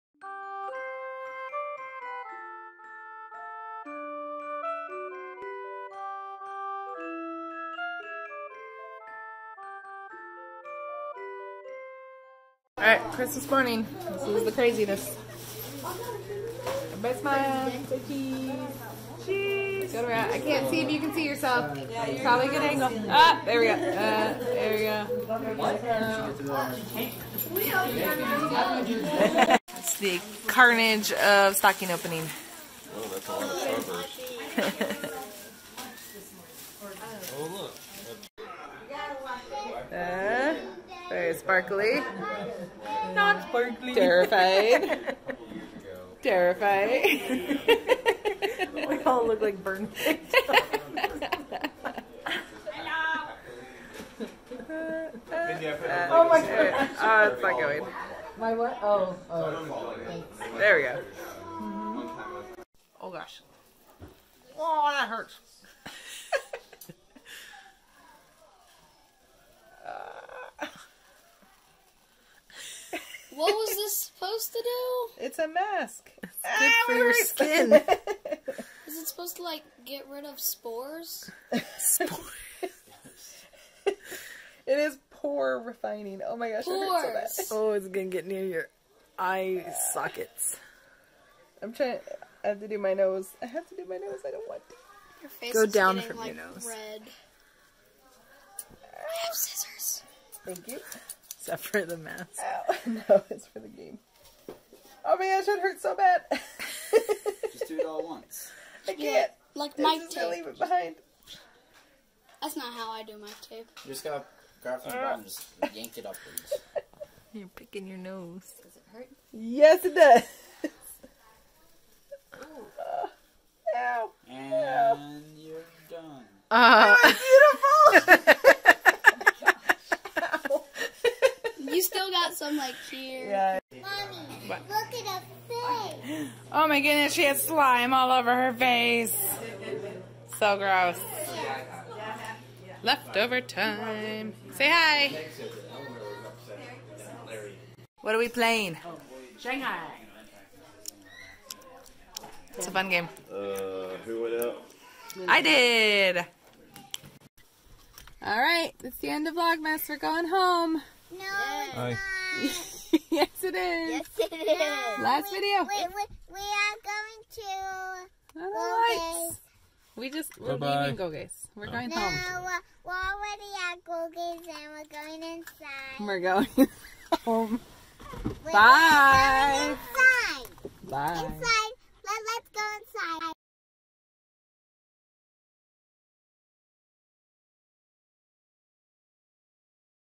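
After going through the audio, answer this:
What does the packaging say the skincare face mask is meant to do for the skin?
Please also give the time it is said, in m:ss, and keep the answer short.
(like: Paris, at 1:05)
Pore refining, at 1:25.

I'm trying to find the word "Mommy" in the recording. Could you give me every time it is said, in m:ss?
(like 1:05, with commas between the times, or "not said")
2:13.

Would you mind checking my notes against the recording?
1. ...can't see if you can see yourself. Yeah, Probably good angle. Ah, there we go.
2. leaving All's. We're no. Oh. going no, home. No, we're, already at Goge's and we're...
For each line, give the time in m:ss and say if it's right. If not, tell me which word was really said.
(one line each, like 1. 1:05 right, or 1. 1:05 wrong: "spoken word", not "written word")
1. 0:20 right
2. 2:50 wrong: "Goge", not "All".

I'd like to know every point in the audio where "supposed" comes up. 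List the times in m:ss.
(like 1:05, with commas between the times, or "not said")
1:13, 1:19.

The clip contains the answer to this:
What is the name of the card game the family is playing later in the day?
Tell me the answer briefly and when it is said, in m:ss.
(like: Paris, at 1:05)
Shanghai, at 2:29.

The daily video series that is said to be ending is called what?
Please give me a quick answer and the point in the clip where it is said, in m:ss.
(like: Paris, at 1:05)
Vlogmas, at 2:39.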